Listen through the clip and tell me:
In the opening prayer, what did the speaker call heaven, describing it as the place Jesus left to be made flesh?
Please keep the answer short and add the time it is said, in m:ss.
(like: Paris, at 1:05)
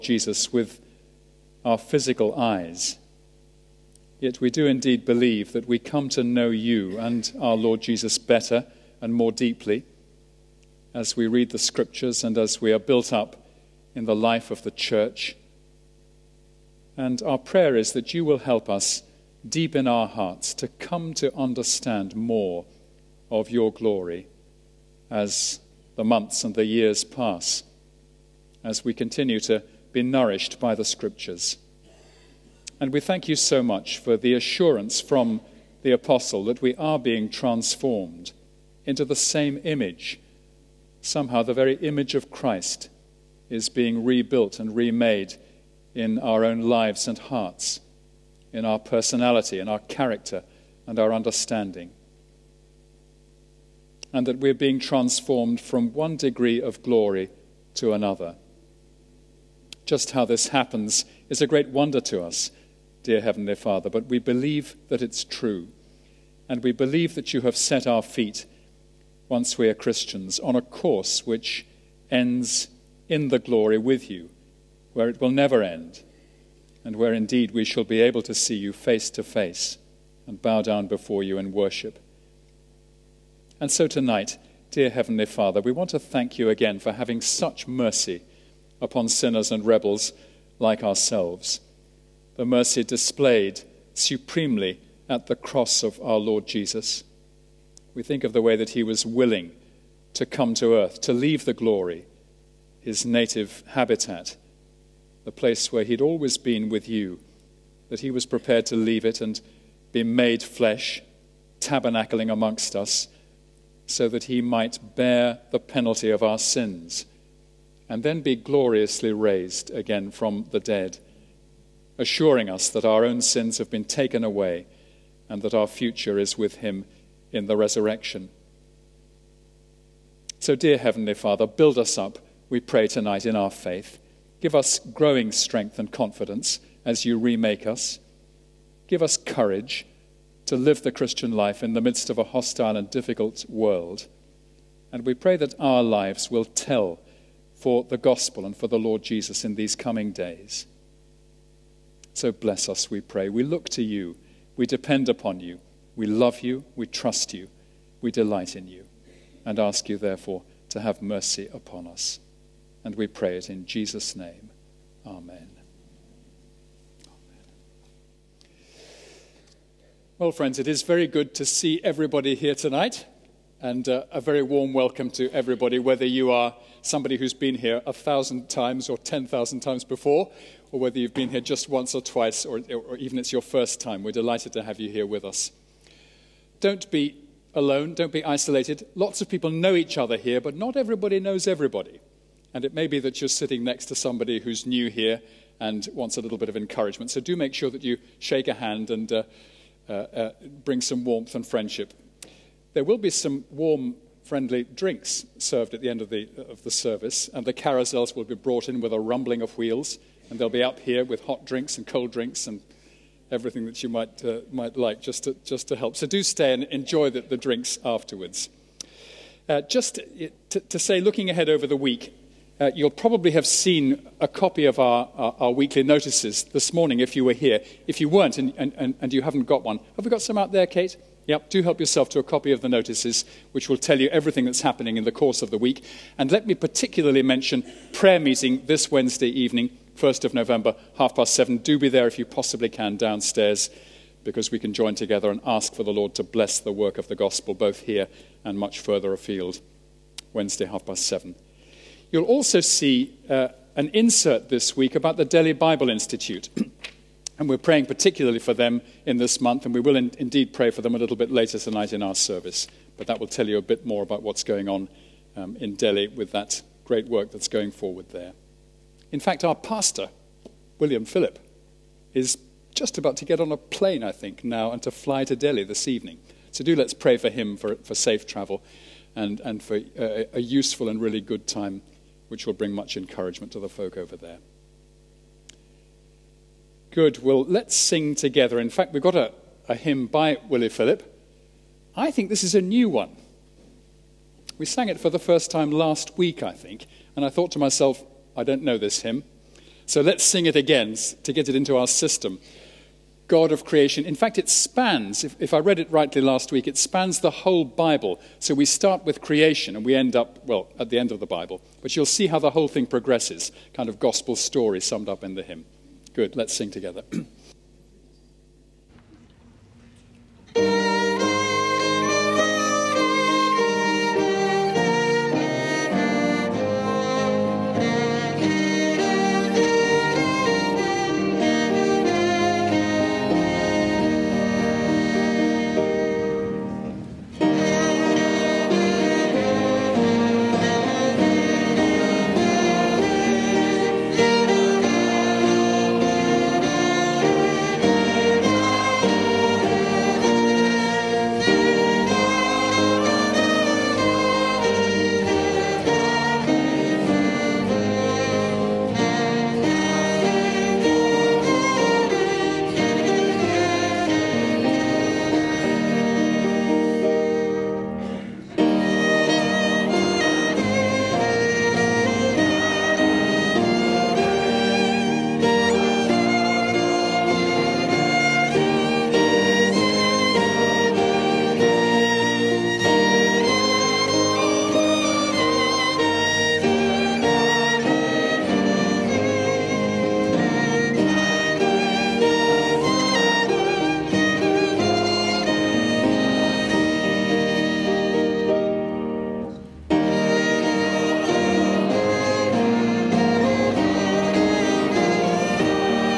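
native habitat, at 1:43.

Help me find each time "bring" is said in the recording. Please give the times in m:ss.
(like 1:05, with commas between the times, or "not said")
3:20, 4:42.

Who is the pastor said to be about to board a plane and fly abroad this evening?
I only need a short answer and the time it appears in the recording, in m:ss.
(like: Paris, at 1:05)
William Phillip, at 4:30.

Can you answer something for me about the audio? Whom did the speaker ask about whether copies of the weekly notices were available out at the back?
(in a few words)
Kate.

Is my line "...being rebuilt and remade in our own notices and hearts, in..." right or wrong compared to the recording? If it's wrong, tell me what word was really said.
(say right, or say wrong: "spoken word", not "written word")
wrong: "lives", not "notices".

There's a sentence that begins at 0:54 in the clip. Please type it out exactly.
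And that we're being transformed from one degree of glory to another.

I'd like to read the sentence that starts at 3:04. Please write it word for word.
We're delighted to have you here with us.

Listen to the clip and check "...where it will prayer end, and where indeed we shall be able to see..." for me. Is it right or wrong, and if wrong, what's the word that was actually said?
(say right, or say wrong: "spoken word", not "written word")
wrong: "never", not "prayer".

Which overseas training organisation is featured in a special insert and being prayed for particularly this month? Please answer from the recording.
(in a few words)
Delhi Bible Institute.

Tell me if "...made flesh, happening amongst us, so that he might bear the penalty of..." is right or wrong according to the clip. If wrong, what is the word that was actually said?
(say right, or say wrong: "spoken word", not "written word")
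wrong: "tabernacling", not "happening".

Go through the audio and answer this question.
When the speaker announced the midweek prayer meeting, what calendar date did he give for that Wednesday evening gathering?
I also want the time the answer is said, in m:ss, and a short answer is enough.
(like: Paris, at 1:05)
1st of November, at 3:59.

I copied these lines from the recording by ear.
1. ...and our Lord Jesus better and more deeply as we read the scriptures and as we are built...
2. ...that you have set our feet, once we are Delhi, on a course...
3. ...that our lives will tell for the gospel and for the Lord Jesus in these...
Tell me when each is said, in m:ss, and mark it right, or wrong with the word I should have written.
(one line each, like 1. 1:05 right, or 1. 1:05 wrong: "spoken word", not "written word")
1. 0:06 right
2. 1:07 wrong: "Christians", not "Delhi"
3. 2:25 right.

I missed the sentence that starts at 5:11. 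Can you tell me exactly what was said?
But you'll see how the whole thing progresses, kind of gospel story summed up in the hymn.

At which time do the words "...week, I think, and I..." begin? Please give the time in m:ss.
4:56.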